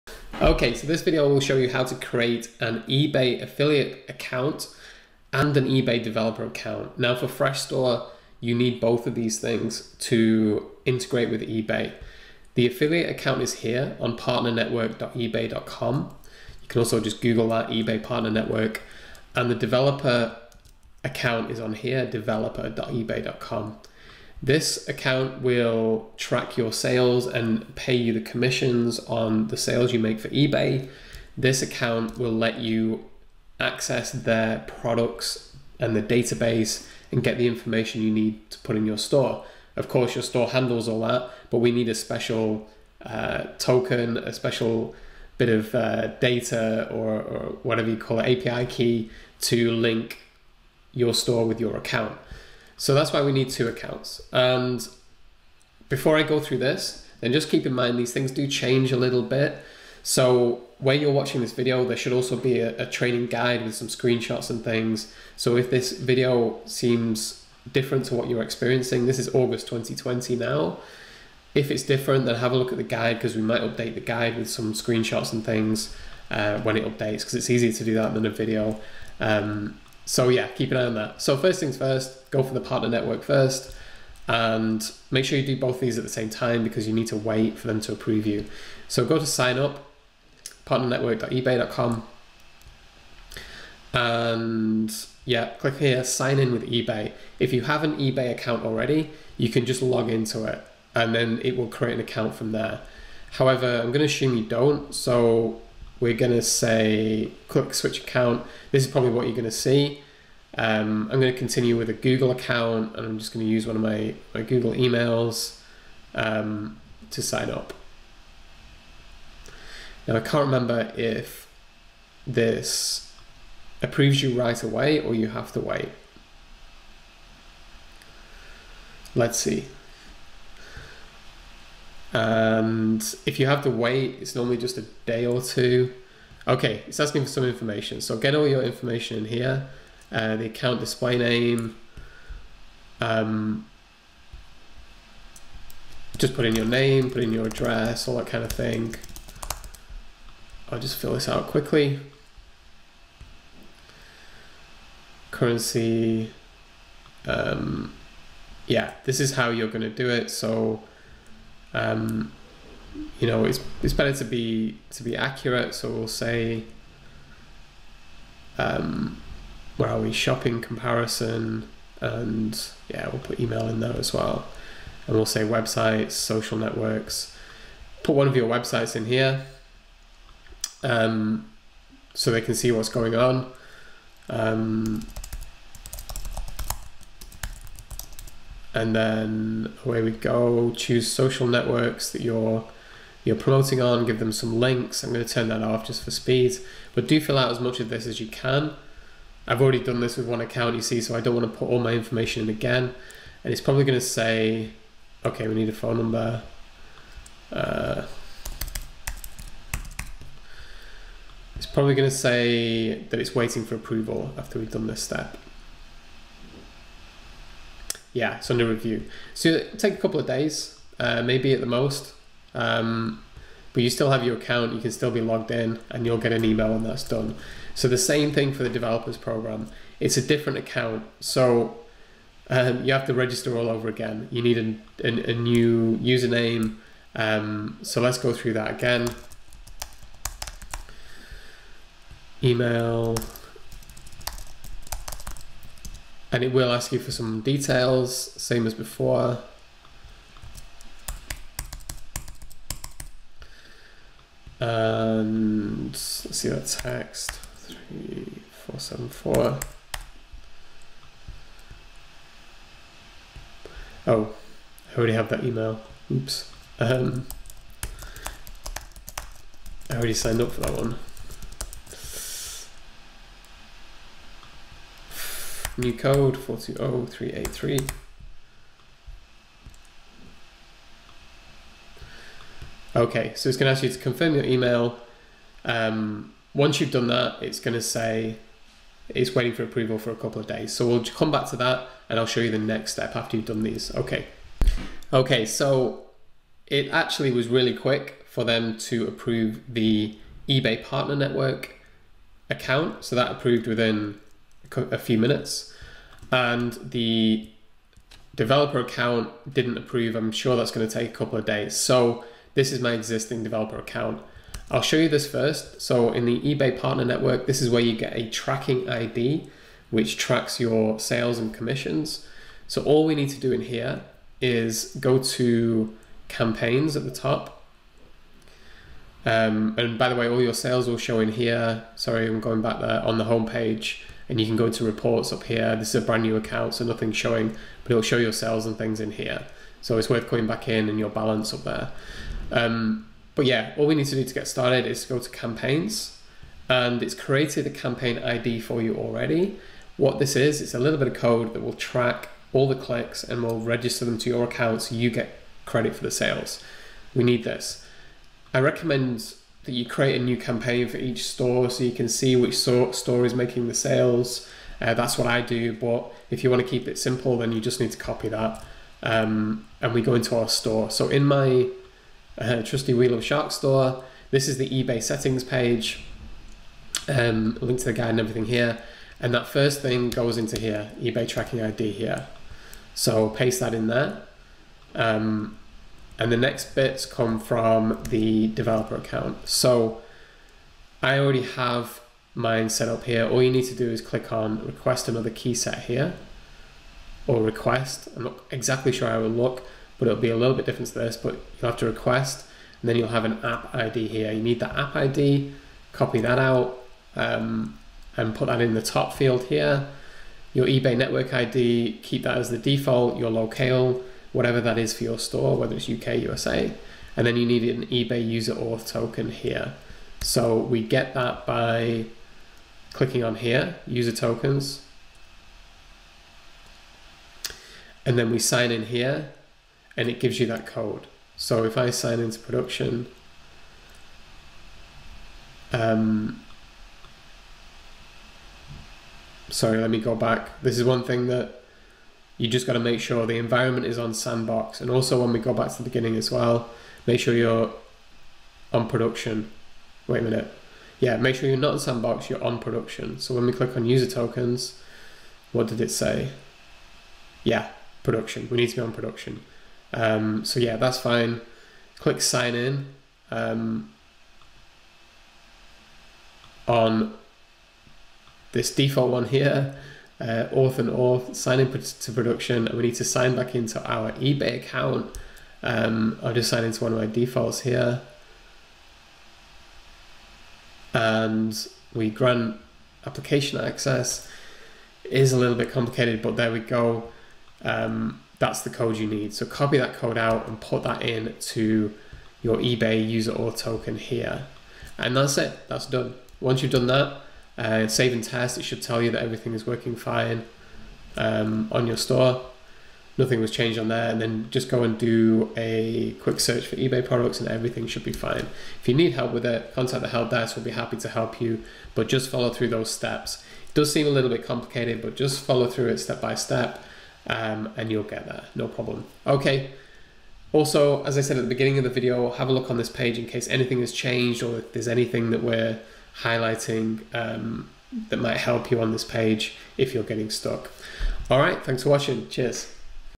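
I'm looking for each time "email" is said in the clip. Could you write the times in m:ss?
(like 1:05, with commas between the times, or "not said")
1:54, 2:53, 3:46, 4:02, 4:25, 4:44.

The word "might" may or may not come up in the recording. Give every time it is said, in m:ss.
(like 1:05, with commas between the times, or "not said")
1:13, 8:48.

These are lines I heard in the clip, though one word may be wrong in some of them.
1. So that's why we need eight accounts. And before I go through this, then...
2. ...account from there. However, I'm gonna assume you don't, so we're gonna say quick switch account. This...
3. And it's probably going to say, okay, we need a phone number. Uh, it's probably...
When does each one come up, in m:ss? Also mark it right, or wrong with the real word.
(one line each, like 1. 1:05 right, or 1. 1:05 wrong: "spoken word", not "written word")
1. 0:52 wrong: "two", not "eight"
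2. 1:41 wrong: "click", not "quick"
3. 3:23 right.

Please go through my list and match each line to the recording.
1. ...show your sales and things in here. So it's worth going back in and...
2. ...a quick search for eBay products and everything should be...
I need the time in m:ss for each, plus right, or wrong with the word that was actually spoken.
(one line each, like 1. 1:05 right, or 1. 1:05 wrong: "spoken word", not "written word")
1. 5:38 right
2. 8:25 right.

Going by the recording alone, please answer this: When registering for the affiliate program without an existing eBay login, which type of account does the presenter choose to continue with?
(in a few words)
Google account.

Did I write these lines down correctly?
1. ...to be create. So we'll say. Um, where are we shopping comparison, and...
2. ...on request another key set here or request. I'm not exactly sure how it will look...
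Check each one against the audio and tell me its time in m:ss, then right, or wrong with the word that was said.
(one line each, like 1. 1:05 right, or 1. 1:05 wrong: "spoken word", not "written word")
1. 2:44 wrong: "accurate", not "create"
2. 6:34 right.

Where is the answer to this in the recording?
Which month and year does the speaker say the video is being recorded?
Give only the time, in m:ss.
1:09.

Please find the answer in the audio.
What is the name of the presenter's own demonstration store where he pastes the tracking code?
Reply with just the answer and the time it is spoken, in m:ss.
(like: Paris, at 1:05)
Wheel of Shark, at 6:12.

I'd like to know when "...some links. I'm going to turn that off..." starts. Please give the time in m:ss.
3:14.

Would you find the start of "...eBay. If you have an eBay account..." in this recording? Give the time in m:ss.
1:36.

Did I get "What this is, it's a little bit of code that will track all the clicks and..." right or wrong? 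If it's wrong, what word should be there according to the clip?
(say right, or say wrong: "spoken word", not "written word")
right.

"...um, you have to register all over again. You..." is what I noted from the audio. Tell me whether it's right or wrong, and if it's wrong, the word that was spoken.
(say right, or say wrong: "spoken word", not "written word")
right.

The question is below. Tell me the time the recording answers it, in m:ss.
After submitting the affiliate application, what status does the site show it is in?
3:38.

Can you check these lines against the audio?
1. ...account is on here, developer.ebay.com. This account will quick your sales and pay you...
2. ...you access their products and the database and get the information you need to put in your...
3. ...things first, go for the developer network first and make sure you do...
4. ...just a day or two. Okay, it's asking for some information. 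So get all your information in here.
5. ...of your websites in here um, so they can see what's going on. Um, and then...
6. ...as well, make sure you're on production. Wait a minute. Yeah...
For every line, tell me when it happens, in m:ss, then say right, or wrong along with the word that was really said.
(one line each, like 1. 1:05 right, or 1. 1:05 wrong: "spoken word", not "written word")
1. 0:21 wrong: "track", not "quick"
2. 0:32 right
3. 1:21 wrong: "partner", not "developer"
4. 2:14 right
5. 2:58 right
6. 7:26 right.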